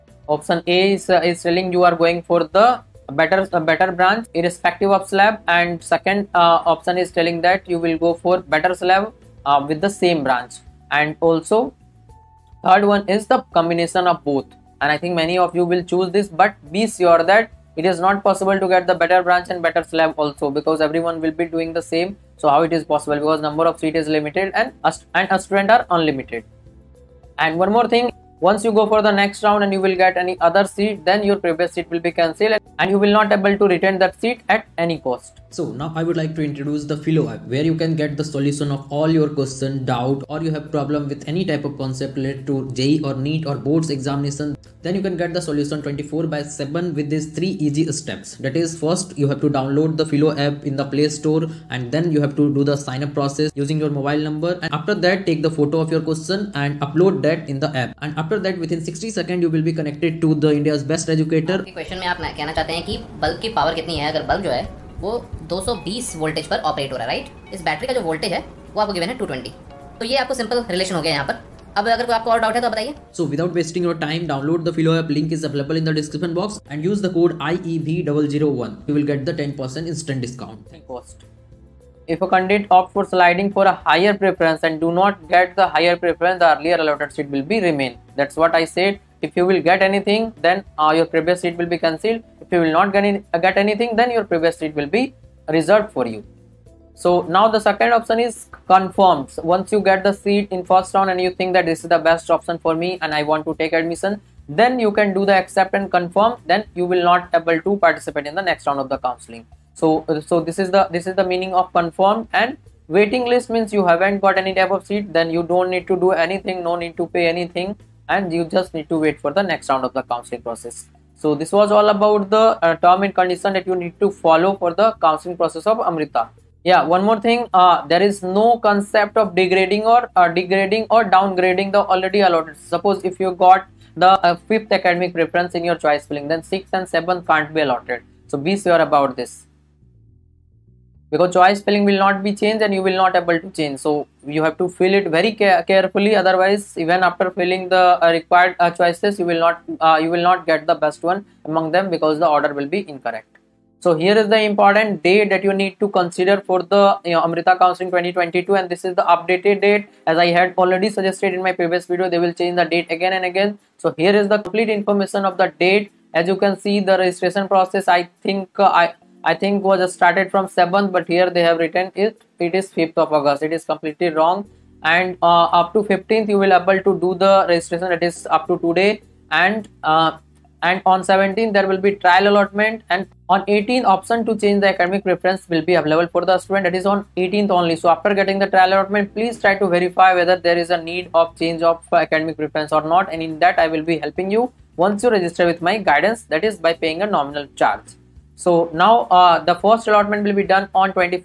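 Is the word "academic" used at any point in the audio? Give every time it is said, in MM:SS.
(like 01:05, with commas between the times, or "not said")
02:14, 03:04, 03:12.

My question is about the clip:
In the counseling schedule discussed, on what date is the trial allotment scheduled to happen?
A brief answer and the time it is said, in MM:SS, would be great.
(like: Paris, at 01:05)
17th, at 03:01.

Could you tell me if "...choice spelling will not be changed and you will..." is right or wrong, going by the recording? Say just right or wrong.
right.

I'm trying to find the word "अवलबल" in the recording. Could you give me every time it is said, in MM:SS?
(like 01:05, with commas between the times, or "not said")
01:15.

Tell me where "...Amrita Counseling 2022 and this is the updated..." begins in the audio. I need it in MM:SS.
02:37.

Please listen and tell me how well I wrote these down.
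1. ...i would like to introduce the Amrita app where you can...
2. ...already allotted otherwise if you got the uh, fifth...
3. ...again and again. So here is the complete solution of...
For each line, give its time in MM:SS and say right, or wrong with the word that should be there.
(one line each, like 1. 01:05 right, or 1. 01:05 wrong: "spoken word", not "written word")
1. 00:36 wrong: "Filo", not "Amrita"
2. 02:11 wrong: "suppose", not "otherwise"
3. 02:42 wrong: "information", not "solution".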